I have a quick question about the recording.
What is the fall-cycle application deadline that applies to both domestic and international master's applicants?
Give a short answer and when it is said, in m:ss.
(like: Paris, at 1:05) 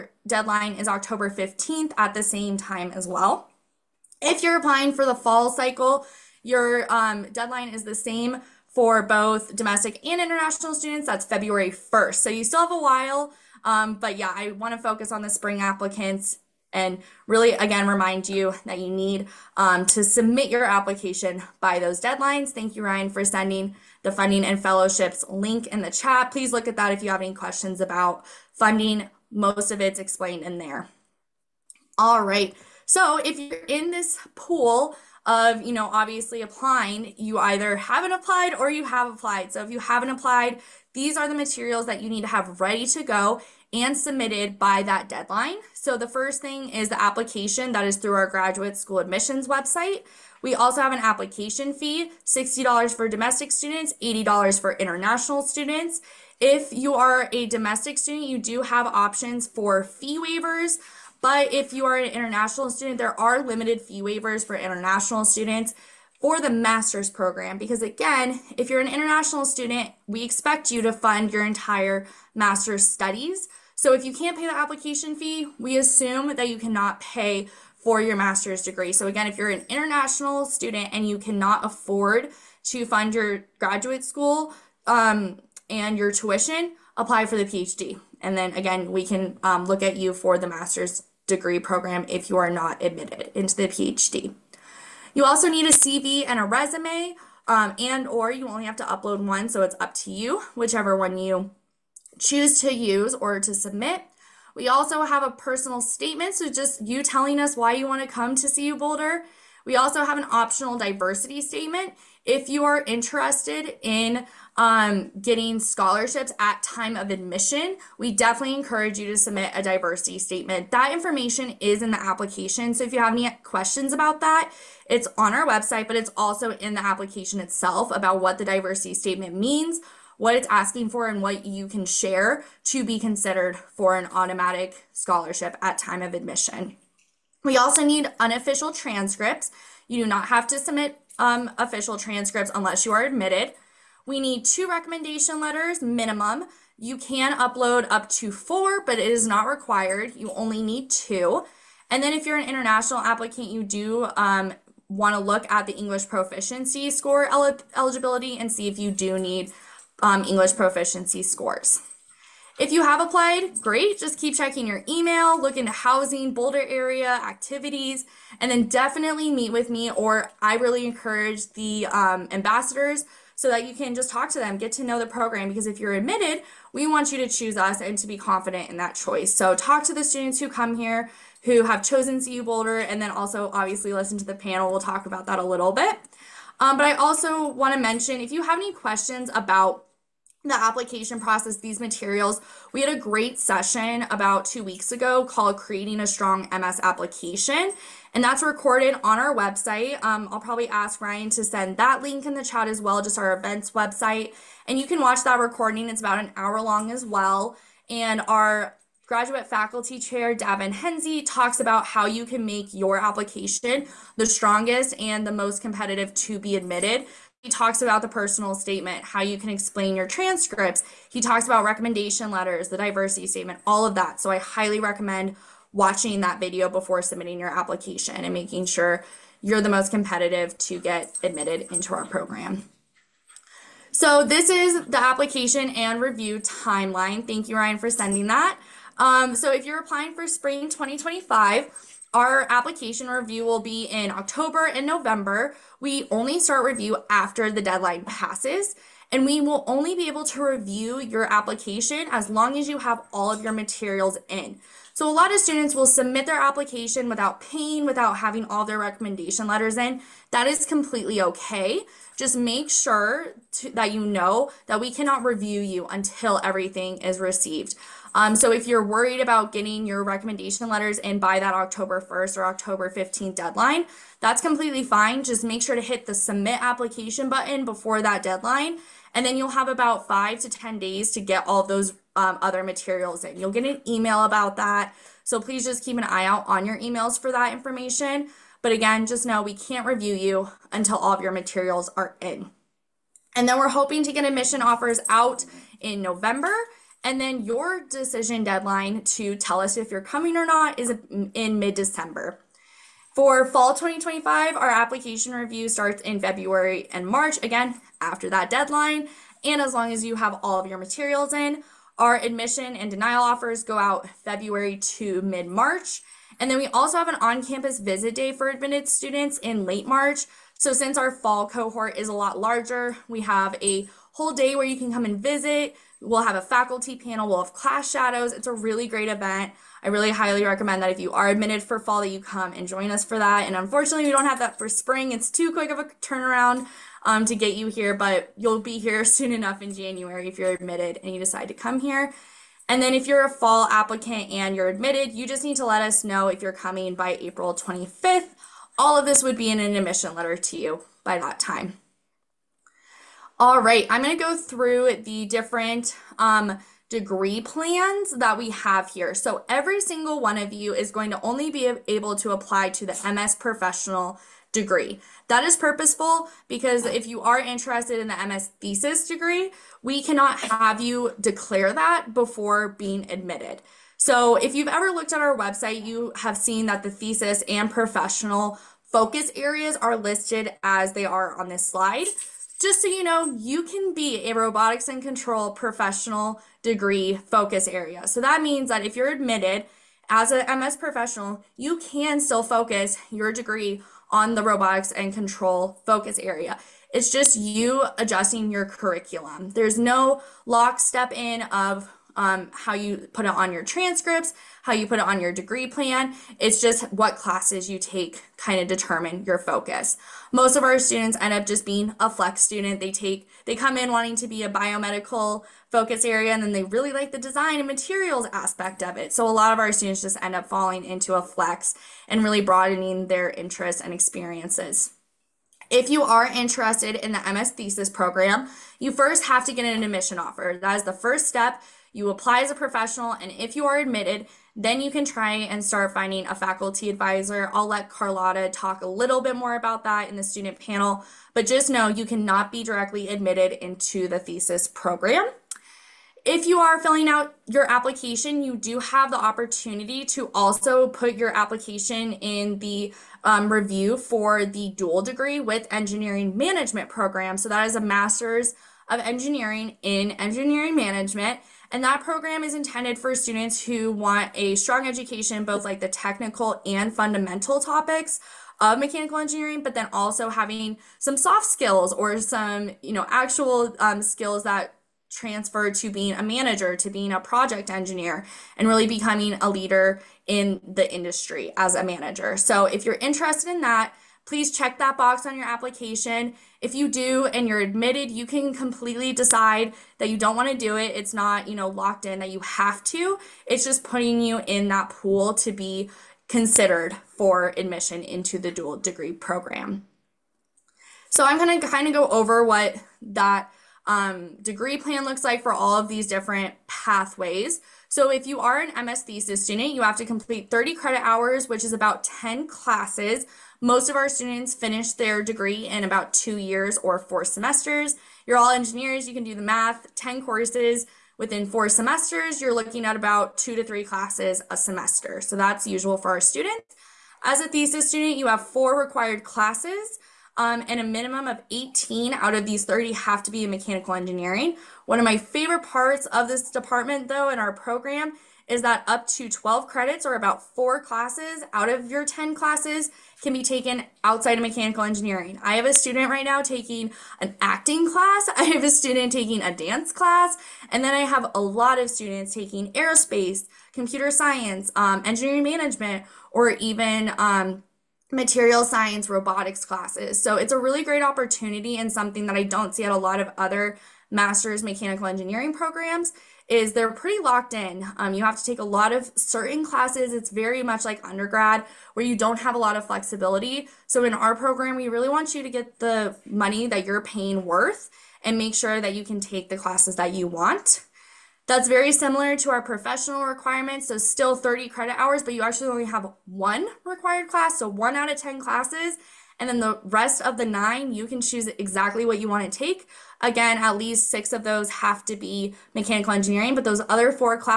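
February 1st, at 0:11.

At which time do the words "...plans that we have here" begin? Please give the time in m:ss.
5:57.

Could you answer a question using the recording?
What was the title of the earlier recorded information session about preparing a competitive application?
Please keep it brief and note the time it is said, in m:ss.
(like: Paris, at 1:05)
Creating a Strong MS Application, at 3:15.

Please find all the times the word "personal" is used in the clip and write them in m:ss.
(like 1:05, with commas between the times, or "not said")
1:45, 3:38.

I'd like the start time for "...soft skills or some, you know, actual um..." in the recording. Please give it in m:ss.
7:51.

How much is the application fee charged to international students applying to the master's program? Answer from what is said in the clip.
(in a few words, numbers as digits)
$80.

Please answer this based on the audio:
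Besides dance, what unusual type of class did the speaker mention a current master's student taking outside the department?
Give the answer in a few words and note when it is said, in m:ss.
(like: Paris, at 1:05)
acting, at 9:07.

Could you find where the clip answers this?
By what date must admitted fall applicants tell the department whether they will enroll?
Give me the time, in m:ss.
5:47.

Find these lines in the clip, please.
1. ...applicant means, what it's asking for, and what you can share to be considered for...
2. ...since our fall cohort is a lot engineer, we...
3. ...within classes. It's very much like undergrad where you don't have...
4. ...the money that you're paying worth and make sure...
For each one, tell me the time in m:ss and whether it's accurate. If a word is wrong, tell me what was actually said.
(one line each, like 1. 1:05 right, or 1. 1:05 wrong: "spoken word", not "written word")
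1. 2:08 wrong: "statement", not "applicant"
2. 5:20 wrong: "larger", not "engineer"
3. 9:29 wrong: "certain", not "within"
4. 9:35 right.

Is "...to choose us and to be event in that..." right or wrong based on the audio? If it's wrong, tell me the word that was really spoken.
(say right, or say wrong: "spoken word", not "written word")
wrong: "confident", not "event".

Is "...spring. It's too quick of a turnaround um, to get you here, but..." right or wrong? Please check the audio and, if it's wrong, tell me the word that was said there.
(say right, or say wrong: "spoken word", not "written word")
right.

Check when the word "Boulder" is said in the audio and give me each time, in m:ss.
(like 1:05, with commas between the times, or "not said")
1:48, 2:46, 3:02.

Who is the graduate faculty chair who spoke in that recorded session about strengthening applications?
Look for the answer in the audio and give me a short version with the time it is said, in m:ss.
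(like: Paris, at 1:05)
Daven Henze, at 3:30.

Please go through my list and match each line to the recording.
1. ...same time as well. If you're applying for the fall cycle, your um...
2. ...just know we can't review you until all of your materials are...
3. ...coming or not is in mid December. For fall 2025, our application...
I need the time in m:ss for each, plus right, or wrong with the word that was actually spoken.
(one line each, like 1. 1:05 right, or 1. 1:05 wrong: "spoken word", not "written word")
1. 0:02 right
2. 4:49 right
3. 5:00 right.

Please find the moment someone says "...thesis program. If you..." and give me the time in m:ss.
7:24.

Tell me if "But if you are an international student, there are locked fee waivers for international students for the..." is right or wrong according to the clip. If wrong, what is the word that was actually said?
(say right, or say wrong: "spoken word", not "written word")
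wrong: "limited", not "locked".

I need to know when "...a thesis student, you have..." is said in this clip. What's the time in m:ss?
8:47.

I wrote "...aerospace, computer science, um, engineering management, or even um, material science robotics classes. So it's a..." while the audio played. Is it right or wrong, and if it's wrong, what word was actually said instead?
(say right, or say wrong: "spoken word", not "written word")
right.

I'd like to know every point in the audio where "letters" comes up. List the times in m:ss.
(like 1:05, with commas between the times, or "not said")
2:25, 3:42, 4:19, 4:30, 5:50.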